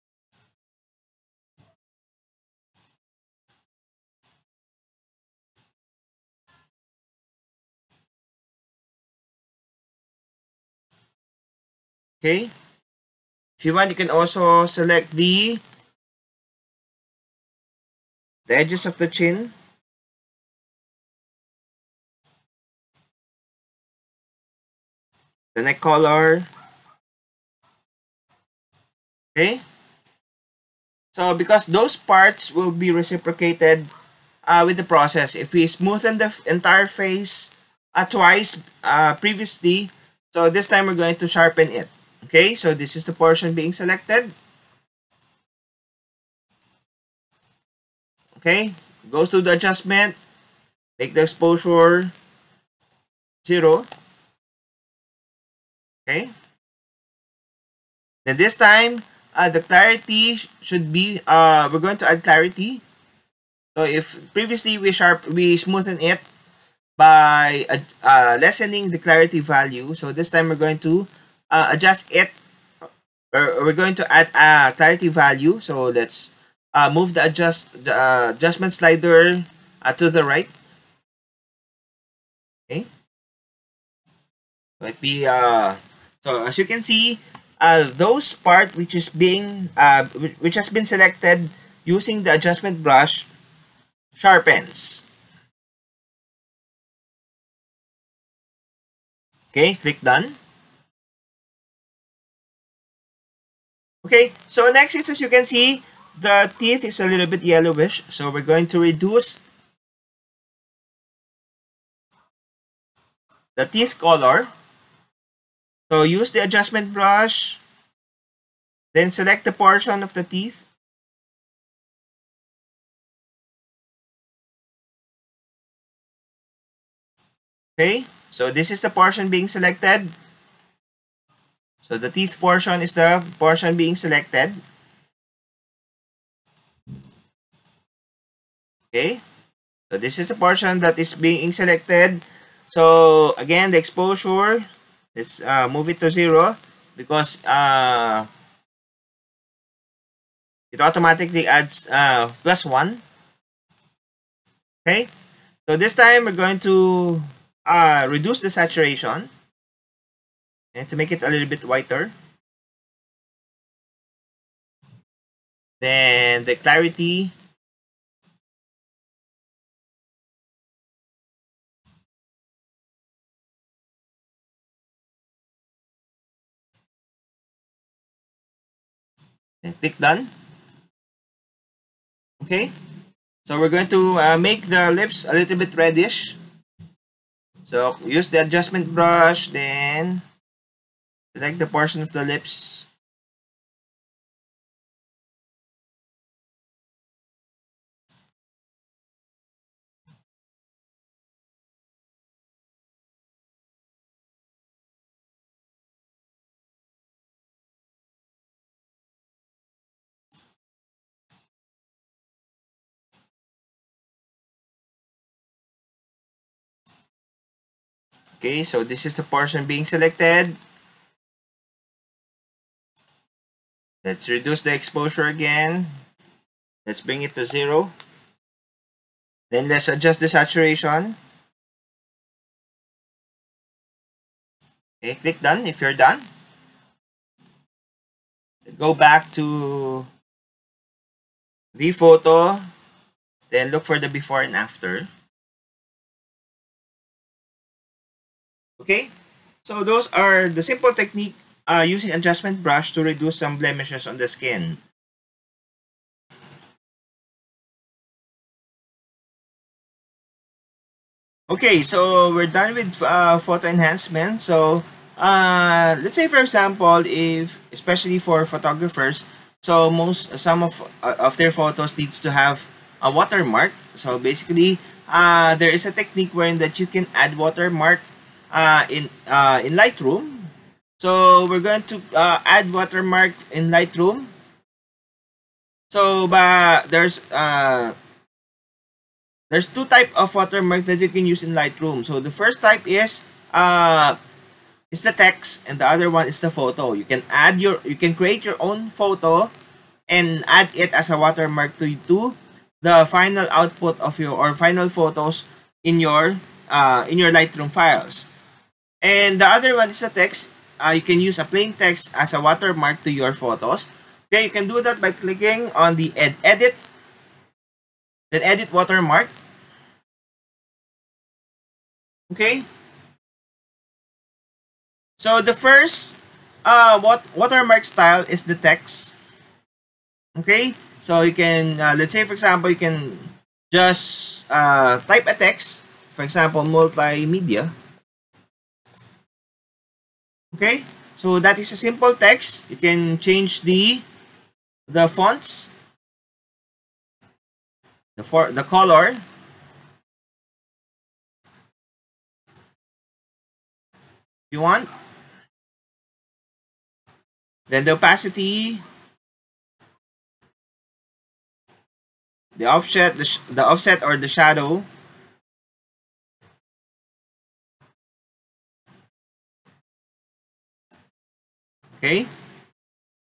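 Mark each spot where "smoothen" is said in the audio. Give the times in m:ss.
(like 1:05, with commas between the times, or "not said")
0:35, 1:05.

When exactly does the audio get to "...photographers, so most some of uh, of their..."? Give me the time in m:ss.
4:28.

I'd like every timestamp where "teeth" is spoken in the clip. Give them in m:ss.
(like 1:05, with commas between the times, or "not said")
1:46, 1:53, 2:00, 2:12.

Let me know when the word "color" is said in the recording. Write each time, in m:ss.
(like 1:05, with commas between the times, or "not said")
0:25, 1:54, 5:48.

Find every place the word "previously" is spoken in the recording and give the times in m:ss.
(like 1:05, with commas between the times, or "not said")
0:39, 1:04.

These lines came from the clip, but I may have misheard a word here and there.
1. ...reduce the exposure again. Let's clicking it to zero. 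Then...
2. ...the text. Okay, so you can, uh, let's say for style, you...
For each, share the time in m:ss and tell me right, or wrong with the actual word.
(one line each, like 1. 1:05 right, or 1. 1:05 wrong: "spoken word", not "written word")
1. 3:44 wrong: "bring", not "clicking"
2. 5:28 wrong: "example", not "style".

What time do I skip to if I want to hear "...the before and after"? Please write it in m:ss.
4:03.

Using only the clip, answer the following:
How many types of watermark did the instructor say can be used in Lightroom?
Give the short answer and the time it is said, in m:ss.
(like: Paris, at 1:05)
2, at 4:49.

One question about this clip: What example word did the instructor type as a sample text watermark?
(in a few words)
Multimedia.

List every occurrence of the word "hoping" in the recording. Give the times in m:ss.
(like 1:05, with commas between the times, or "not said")
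not said.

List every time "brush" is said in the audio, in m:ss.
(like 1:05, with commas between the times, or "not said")
1:32, 1:56, 3:08, 4:12.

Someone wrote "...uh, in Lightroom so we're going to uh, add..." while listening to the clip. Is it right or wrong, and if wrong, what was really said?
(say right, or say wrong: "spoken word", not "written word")
right.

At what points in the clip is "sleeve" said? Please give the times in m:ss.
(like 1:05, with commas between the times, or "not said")
not said.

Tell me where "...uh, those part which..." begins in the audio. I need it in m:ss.
1:27.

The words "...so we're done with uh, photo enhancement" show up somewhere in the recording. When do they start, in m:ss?
4:21.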